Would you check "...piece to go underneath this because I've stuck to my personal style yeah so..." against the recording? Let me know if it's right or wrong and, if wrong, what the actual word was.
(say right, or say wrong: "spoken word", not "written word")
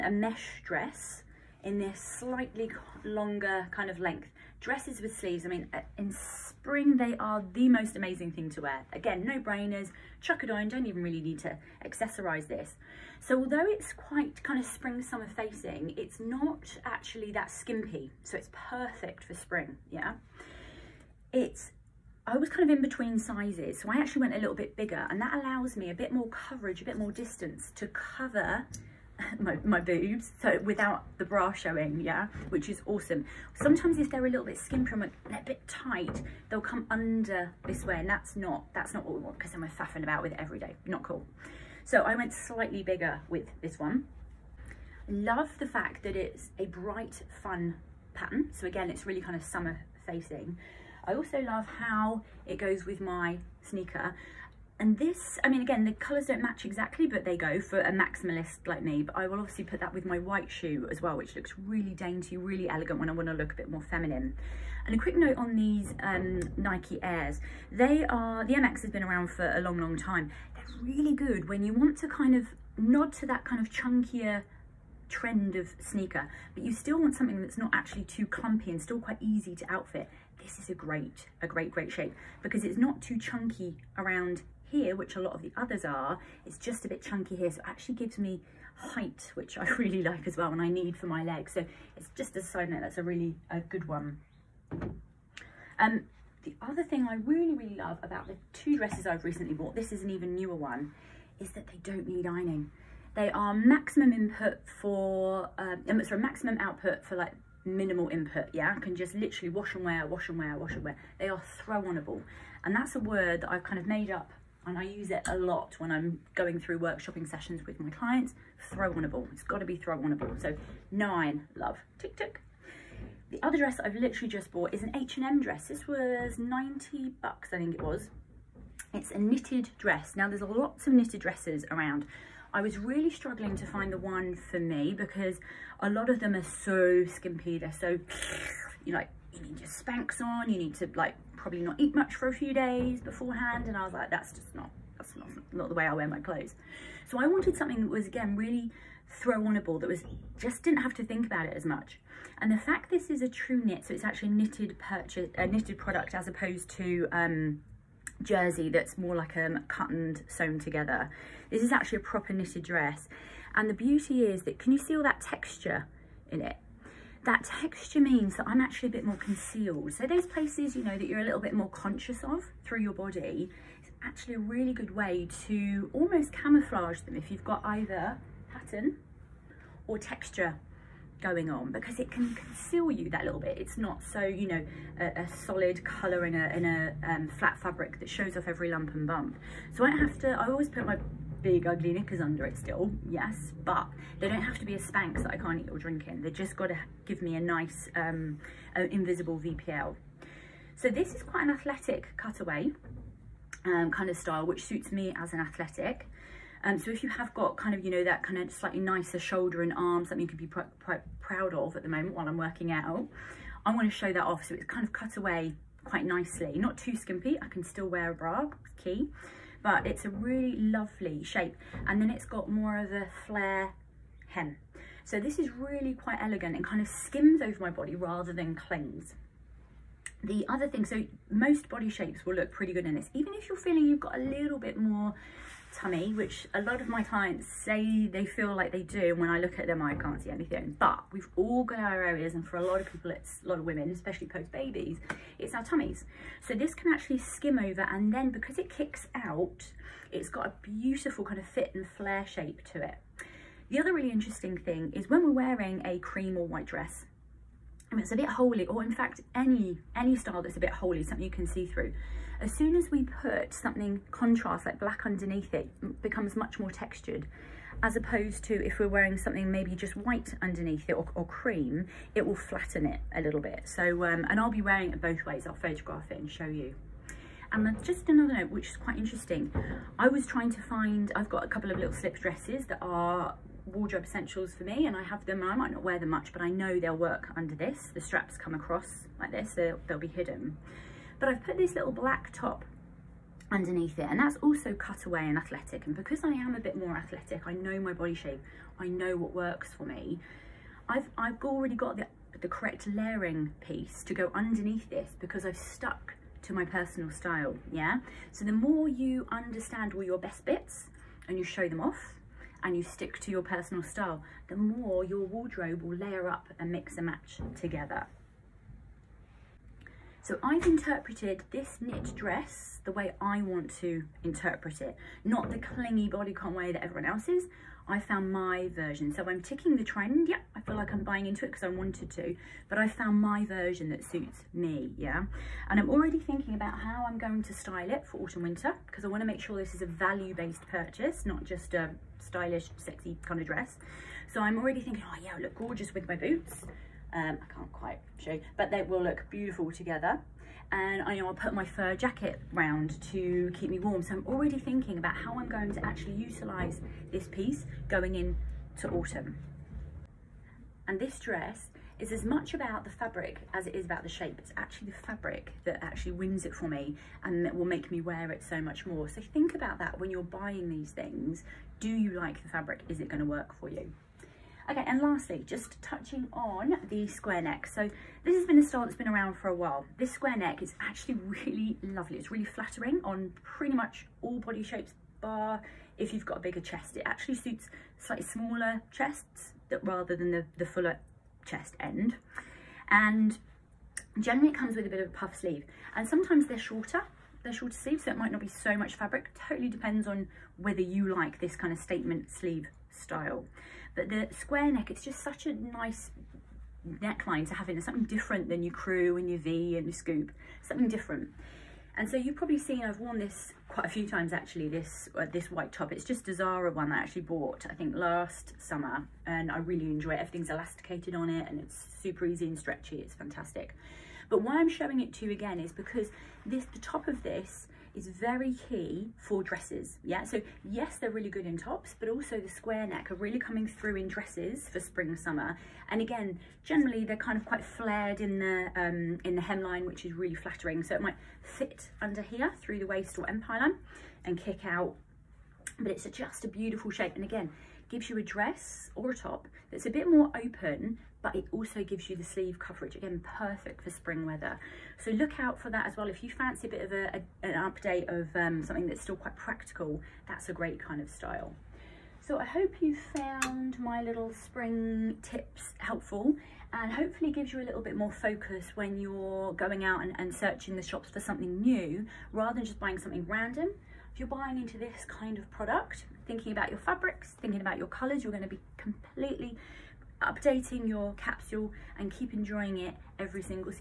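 right.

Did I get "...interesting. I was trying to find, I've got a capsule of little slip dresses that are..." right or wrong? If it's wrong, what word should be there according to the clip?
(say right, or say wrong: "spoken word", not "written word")
wrong: "couple", not "capsule".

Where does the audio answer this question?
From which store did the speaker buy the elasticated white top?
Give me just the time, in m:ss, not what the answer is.
6:56.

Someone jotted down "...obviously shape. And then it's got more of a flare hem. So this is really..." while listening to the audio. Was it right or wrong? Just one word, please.
wrong.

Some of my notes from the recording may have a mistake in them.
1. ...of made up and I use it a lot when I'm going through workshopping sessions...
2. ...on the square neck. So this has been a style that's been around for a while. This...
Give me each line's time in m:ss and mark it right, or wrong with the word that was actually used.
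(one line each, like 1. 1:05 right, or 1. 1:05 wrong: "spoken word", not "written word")
1. 1:53 right
2. 6:16 right.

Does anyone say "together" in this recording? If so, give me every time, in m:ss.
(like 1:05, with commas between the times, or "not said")
2:40, 5:17, 5:49.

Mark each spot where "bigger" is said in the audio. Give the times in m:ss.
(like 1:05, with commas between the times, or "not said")
0:24, 0:42, 6:26.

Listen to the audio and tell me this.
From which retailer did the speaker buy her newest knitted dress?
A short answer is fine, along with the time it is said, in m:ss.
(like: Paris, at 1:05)
H&M, at 2:04.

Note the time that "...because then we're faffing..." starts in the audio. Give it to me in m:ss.
0:39.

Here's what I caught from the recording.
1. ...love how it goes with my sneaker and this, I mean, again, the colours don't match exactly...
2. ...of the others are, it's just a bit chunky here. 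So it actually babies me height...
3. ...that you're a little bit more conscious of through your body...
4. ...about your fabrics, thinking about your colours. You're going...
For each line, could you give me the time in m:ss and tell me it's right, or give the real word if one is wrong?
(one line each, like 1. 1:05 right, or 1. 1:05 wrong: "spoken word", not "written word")
1. 0:51 right
2. 1:25 wrong: "gives", not "babies"
3. 2:50 right
4. 7:56 right.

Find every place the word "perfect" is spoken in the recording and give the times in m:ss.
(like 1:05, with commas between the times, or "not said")
0:18, 7:33.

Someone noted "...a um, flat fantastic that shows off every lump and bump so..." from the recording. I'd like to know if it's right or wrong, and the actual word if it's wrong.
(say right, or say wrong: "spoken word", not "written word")
wrong: "fabric", not "fantastic".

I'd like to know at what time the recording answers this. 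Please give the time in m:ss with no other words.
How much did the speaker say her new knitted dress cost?
2:06.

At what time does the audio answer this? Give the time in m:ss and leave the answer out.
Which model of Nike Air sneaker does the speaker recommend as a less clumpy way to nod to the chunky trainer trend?
1:08.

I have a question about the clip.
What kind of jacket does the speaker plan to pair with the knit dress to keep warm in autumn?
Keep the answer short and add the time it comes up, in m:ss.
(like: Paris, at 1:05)
fur jacket, at 5:51.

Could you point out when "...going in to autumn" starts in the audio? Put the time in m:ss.
5:57.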